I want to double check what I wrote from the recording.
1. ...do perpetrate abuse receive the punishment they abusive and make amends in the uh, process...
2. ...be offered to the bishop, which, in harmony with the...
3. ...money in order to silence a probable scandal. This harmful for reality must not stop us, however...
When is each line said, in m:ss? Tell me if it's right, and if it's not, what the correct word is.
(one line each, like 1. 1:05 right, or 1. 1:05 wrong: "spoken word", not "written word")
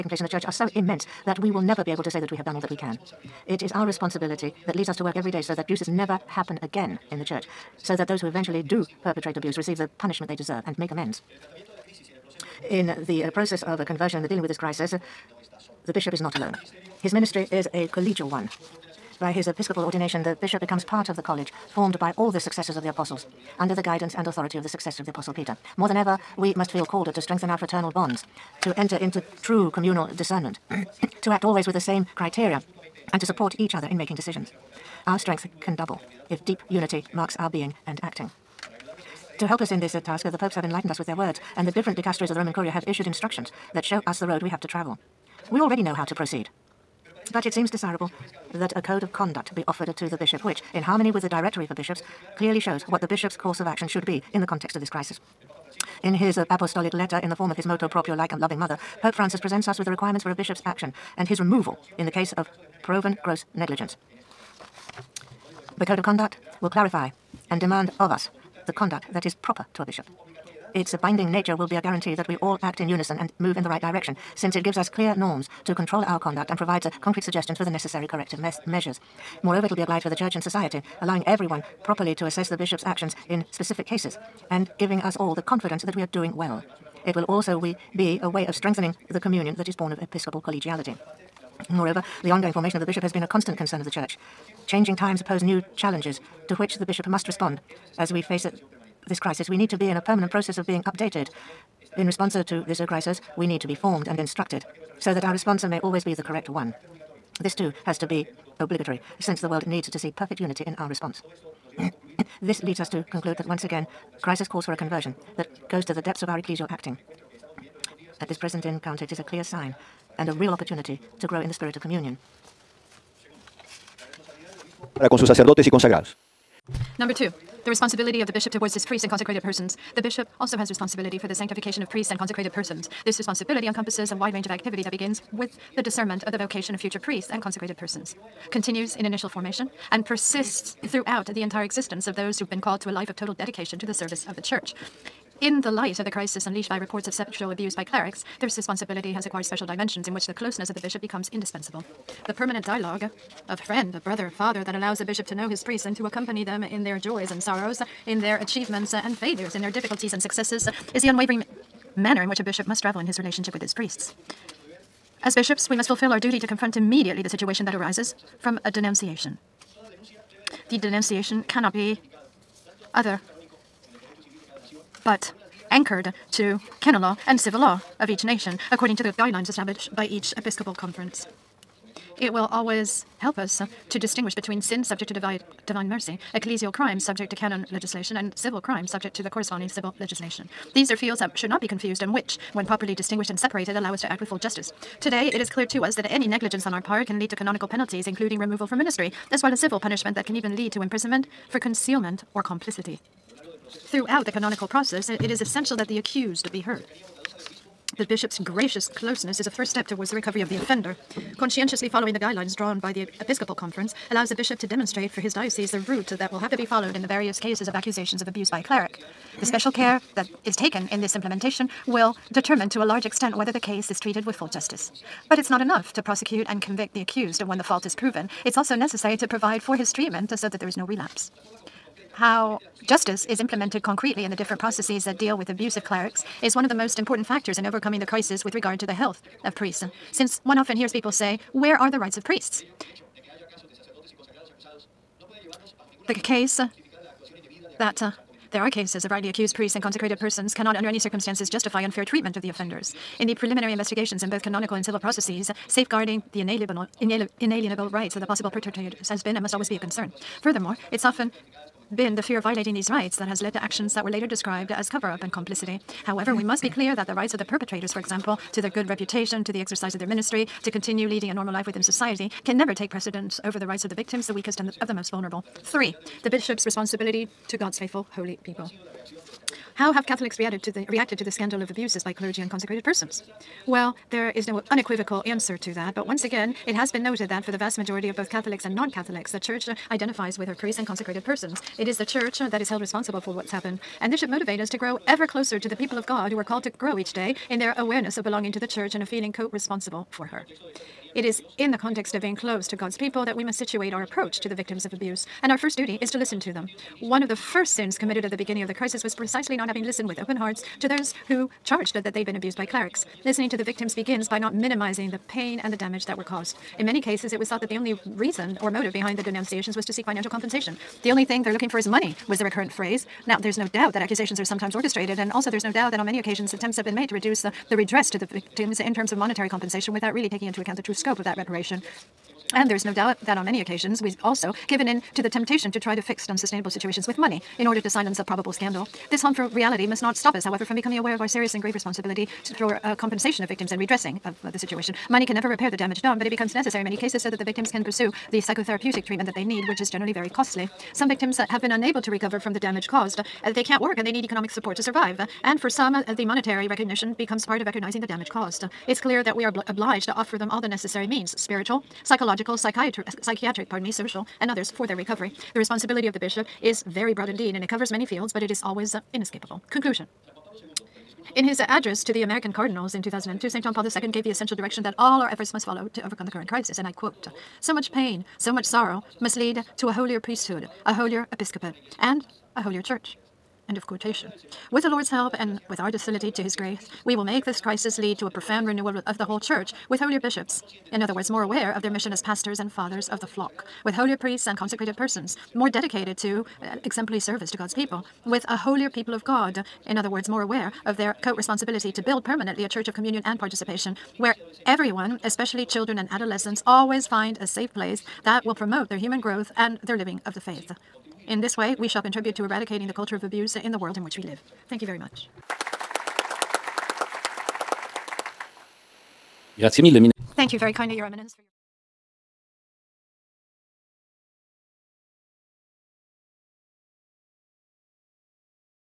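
1. 0:08 wrong: "deserve", not "abusive"
2. 0:49 right
3. 5:37 right.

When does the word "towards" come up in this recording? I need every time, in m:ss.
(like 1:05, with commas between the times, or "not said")
2:08, 3:29.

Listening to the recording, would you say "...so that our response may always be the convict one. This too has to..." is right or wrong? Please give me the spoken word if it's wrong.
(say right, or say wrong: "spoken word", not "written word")
wrong: "correct", not "convict".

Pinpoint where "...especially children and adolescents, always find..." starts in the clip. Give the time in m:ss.
6:45.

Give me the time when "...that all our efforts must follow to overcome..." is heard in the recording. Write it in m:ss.
6:14.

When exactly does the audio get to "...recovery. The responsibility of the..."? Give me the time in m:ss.
6:04.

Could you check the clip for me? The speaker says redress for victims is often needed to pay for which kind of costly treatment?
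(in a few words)
psychotherapeutic treatment.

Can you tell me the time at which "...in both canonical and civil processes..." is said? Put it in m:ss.
4:14.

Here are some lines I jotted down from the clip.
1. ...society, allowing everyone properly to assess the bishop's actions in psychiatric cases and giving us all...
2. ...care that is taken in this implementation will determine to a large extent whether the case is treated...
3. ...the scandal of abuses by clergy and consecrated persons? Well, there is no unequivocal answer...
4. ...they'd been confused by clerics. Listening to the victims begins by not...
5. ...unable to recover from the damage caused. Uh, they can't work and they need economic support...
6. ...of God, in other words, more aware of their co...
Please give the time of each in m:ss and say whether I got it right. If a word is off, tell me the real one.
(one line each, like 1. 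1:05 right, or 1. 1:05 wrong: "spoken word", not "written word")
1. 1:20 wrong: "specific", not "psychiatric"
2. 3:39 right
3. 4:41 right
4. 5:12 wrong: "abused", not "confused"
5. 5:51 right
6. 6:39 right.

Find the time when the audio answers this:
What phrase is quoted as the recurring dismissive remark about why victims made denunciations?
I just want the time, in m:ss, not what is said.
5:21.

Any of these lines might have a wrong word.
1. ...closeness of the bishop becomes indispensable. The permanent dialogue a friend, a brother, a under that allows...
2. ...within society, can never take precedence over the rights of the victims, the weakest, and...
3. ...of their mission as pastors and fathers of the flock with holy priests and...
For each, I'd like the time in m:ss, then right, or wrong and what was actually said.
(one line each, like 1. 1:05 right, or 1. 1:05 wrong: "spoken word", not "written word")
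1. 2:30 wrong: "father", not "under"
2. 4:31 right
3. 6:31 right.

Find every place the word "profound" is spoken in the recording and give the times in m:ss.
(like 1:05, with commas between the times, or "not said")
6:28.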